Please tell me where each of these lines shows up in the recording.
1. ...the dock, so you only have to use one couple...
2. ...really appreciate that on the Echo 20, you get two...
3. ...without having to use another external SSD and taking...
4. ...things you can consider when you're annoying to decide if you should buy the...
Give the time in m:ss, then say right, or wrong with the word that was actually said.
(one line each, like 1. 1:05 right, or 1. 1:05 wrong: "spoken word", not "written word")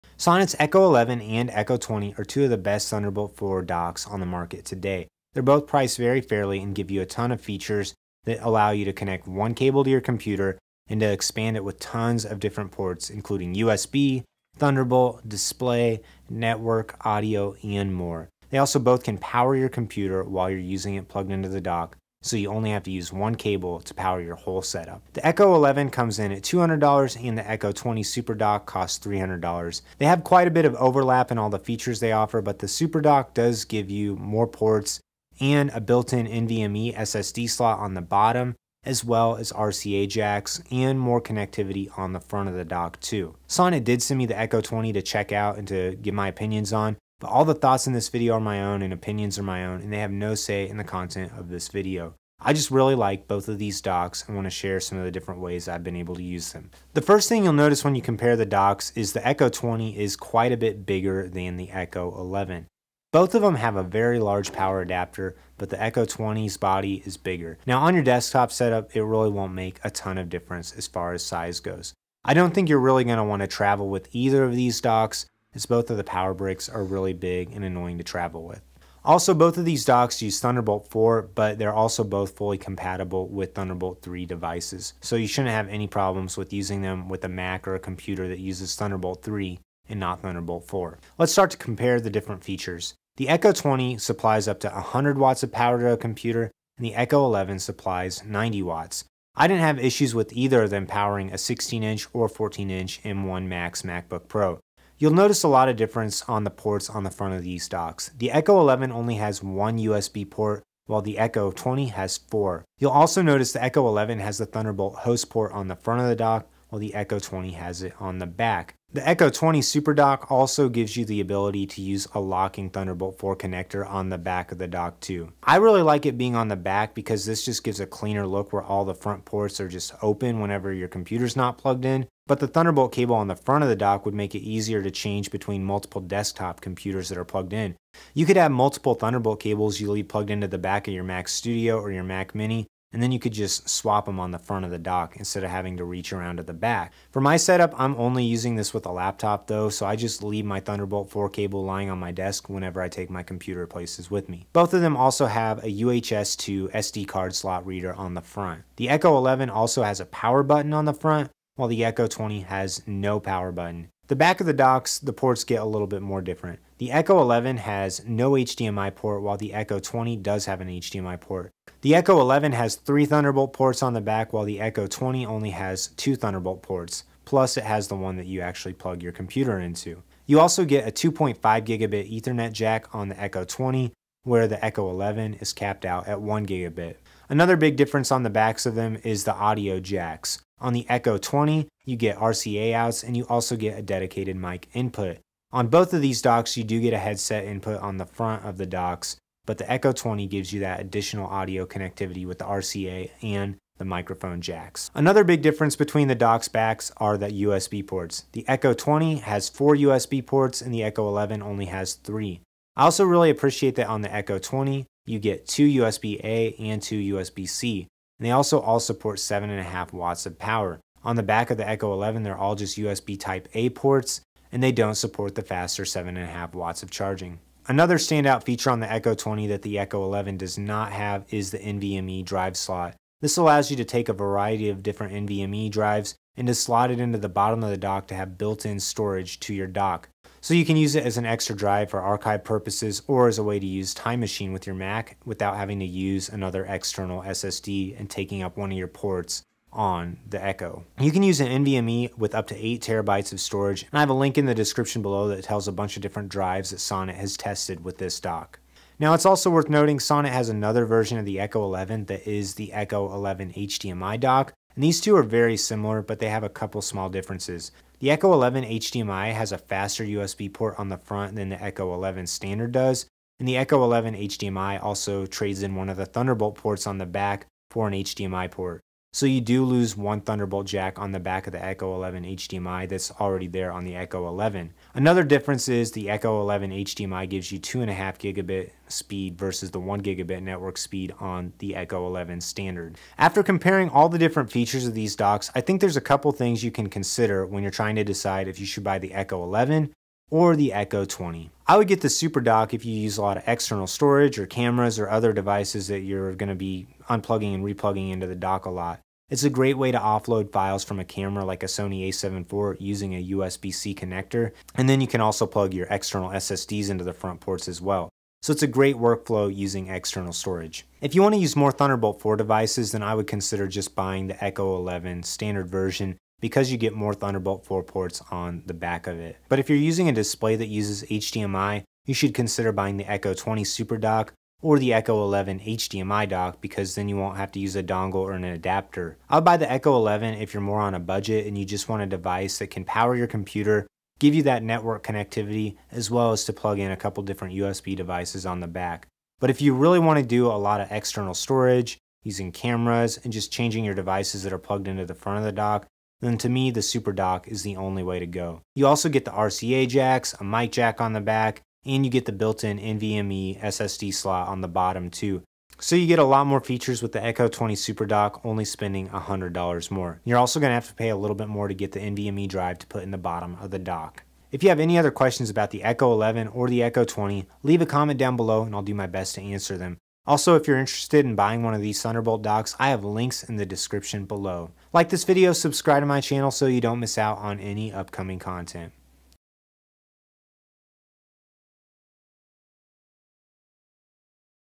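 1. 0:21 wrong: "cable", not "couple"
2. 3:33 right
3. 4:05 right
4. 4:56 wrong: "trying", not "annoying".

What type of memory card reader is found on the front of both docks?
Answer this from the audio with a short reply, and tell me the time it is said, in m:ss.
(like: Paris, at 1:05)
UHS 2 SD, at 2:35.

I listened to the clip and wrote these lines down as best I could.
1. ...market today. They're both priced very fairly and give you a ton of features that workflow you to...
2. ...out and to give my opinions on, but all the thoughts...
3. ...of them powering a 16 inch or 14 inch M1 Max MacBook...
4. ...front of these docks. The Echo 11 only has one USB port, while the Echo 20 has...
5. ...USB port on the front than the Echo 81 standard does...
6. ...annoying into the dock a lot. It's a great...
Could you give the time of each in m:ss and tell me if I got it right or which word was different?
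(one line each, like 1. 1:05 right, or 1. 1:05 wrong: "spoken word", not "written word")
1. 0:04 wrong: "allow", not "workflow"
2. 0:45 right
3. 1:40 right
4. 1:47 right
5. 4:30 wrong: "11", not "81"
6. 5:07 wrong: "replugging", not "annoying".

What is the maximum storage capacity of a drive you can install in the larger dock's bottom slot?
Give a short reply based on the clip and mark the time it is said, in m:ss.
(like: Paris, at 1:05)
8 terabytes, at 4:12.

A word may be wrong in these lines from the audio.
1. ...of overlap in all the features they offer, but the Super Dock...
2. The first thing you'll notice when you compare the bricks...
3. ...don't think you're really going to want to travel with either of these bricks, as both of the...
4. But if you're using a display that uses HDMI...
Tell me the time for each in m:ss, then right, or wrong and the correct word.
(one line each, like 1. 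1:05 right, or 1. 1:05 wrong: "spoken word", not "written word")
1. 0:30 right
2. 0:56 wrong: "docks", not "bricks"
3. 1:12 wrong: "docks", not "bricks"
4. 5:29 right.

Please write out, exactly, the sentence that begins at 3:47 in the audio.
Another standout feature on the Echo 20 that the Echo 11 does not have is the NVMe drive slot.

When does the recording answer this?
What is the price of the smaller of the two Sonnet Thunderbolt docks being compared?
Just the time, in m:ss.
0:26.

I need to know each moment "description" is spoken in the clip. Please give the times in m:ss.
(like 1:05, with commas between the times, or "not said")
4:14, 6:23.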